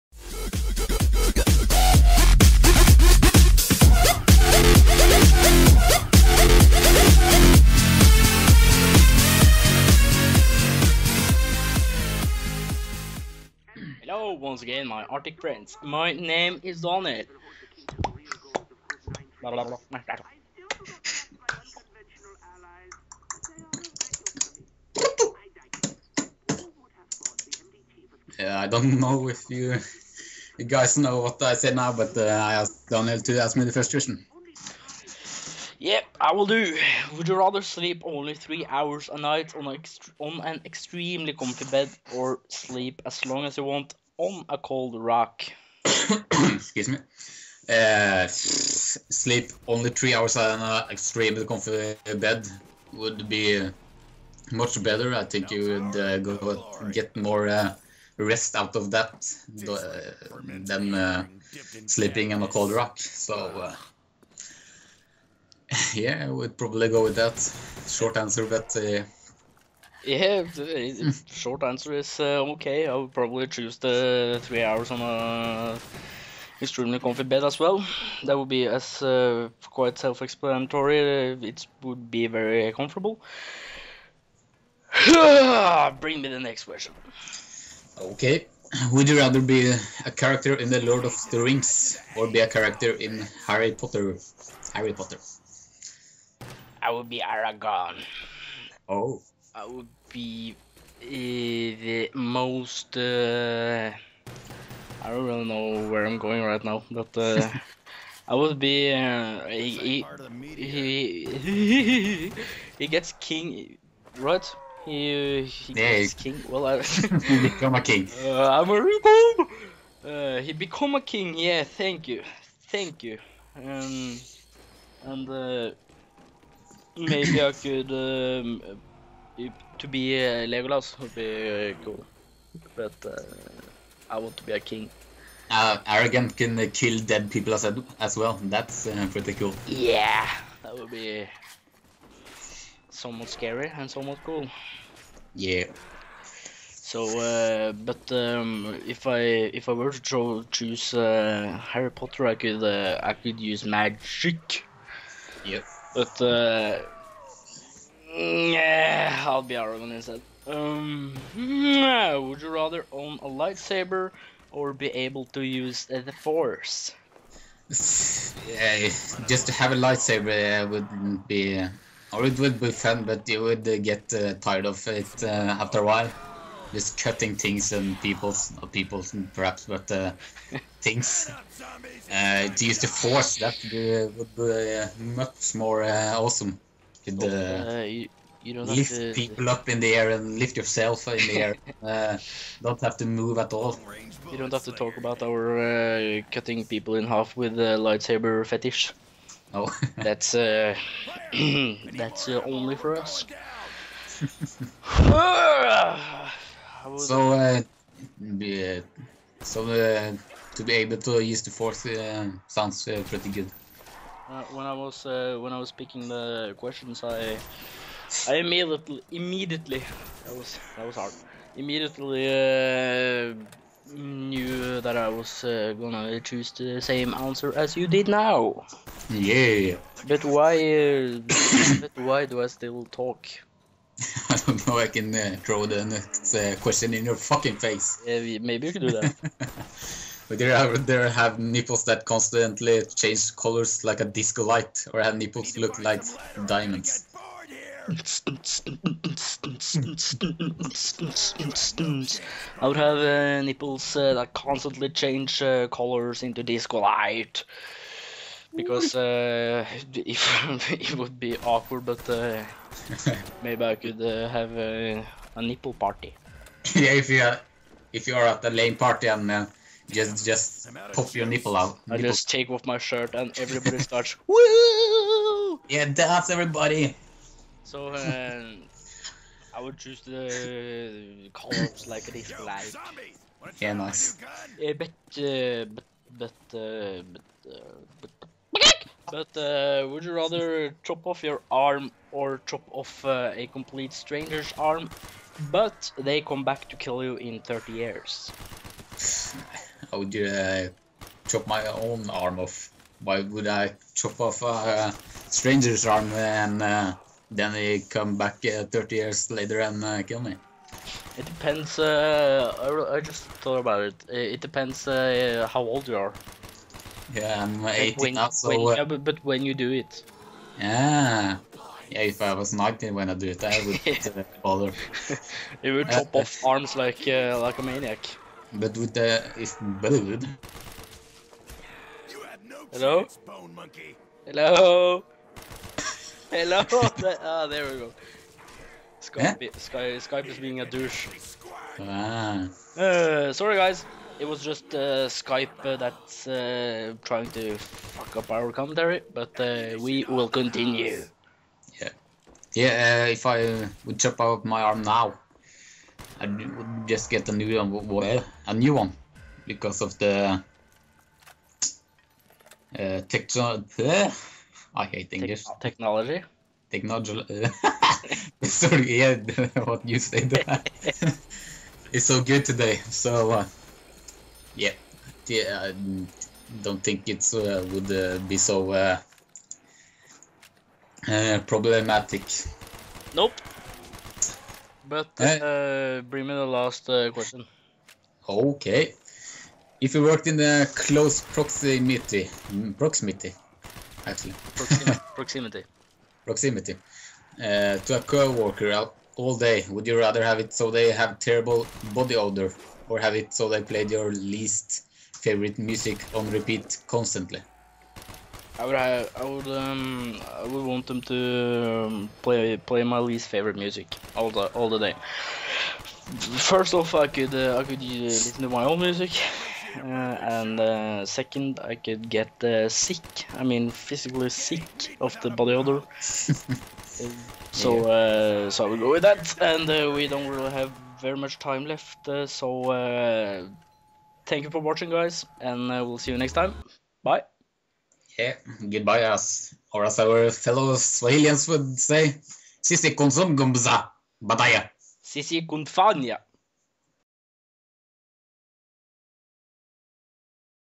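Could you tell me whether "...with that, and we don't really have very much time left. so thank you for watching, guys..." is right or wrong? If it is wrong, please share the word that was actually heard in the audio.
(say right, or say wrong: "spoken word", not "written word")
right.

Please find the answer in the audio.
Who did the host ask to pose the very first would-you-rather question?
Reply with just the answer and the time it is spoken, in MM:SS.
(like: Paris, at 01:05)
Daniel, at 00:32.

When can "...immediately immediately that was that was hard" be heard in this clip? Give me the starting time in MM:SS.
03:38.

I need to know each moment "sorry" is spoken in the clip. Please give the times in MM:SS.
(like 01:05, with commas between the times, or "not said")
05:43, 06:08.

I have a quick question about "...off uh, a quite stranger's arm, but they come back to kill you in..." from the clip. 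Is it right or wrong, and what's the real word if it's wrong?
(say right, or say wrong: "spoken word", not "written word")
wrong: "complete", not "quite".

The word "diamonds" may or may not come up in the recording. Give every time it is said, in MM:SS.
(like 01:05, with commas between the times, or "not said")
04:06.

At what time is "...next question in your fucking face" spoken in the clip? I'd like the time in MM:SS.
03:55.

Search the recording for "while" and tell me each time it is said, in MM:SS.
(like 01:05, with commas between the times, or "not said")
02:55.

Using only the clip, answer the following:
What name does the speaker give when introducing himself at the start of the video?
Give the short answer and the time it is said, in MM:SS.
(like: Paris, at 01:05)
Donald, at 00:16.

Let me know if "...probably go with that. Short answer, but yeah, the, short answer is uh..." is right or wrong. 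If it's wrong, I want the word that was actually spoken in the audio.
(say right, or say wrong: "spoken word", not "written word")
right.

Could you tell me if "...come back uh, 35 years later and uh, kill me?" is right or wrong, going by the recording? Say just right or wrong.
wrong.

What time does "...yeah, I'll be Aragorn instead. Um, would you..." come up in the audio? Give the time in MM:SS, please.
02:38.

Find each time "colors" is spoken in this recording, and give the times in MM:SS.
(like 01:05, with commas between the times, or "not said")
04:03, 04:15, 04:41.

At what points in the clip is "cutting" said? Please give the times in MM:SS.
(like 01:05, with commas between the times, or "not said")
02:57, 03:16.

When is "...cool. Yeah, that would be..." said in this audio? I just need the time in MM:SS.
02:19.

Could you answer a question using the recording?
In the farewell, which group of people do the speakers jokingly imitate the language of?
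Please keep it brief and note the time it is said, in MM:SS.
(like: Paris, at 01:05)
Swahilians, at 07:20.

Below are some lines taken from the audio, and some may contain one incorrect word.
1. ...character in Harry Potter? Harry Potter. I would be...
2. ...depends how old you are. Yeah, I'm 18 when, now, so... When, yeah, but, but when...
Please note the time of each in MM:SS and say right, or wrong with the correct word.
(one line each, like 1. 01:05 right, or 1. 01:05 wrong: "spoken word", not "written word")
1. 01:32 right
2. 05:14 right.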